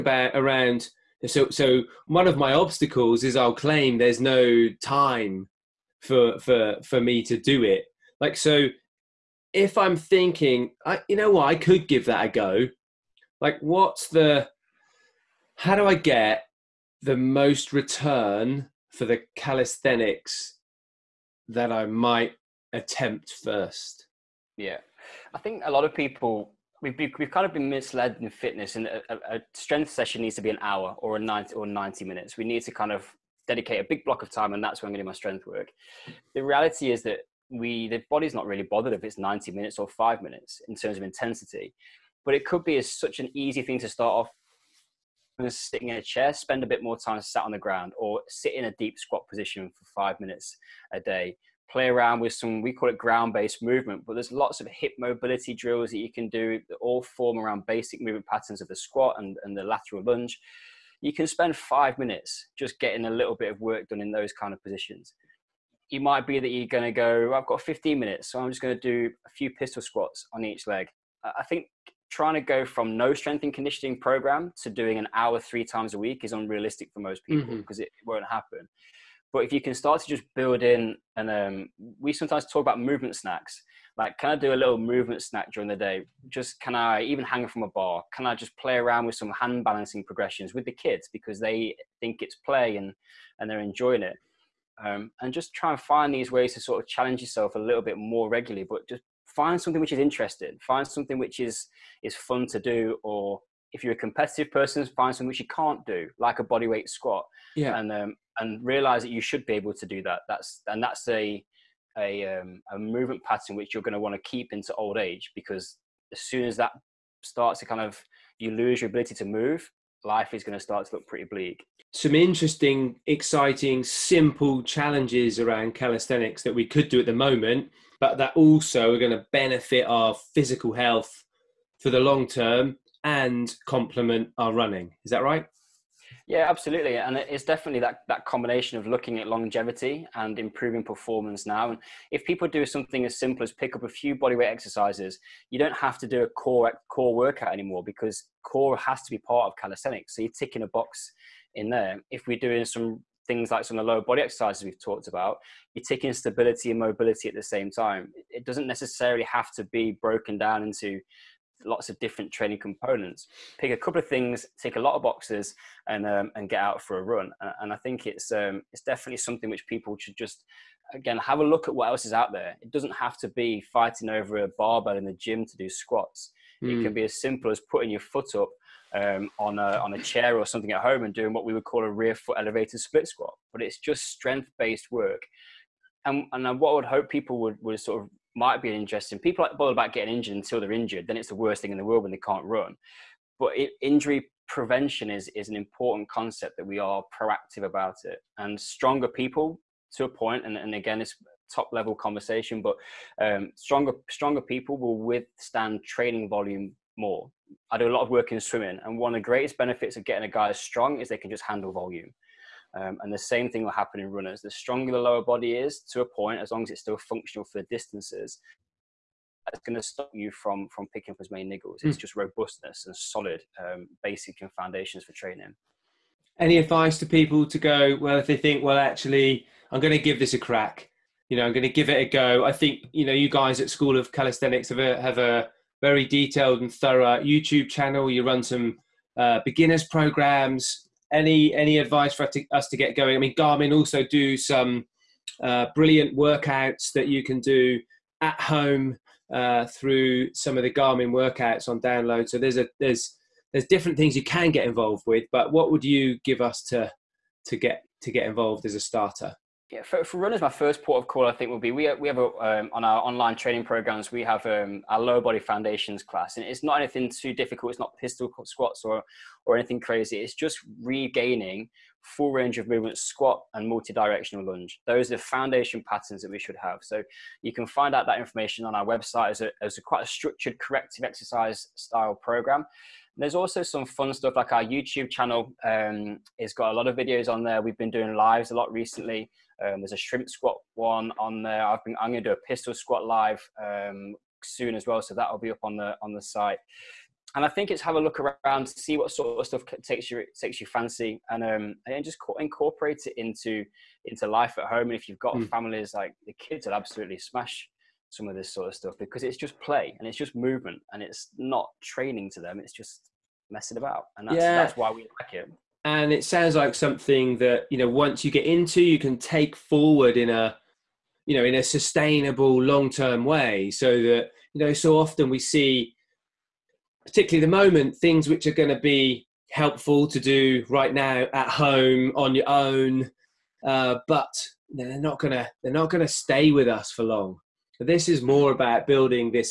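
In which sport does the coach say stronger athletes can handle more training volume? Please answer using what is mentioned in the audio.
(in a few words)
swimming.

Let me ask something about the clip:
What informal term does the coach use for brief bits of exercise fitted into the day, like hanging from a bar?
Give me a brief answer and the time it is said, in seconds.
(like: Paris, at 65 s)
movement snacks, at 82 s.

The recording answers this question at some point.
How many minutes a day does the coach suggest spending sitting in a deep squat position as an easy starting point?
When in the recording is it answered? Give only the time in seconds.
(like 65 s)
49 s.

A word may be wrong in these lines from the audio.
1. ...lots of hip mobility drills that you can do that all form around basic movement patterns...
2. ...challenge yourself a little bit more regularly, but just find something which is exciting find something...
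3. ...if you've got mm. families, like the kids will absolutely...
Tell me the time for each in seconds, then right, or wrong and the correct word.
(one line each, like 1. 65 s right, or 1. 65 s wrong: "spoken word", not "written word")
1. 54 s right
2. 96 s wrong: "interesting", not "exciting"
3. 304 s right.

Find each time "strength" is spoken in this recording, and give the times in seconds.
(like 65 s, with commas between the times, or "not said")
29 s, 35 s, 73 s, 184 s.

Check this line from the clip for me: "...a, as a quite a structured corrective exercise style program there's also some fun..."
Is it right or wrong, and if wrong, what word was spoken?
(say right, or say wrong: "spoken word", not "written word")
right.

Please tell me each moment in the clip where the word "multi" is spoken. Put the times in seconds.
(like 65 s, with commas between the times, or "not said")
273 s.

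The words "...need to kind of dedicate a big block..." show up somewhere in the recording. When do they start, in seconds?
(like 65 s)
32 s.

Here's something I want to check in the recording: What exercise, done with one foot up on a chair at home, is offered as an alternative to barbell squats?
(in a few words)
rear foot elevated split squat.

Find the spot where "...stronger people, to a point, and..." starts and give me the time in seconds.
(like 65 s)
198 s.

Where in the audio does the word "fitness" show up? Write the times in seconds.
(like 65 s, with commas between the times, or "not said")
28 s.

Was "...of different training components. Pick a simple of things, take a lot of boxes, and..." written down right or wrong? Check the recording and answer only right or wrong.
wrong.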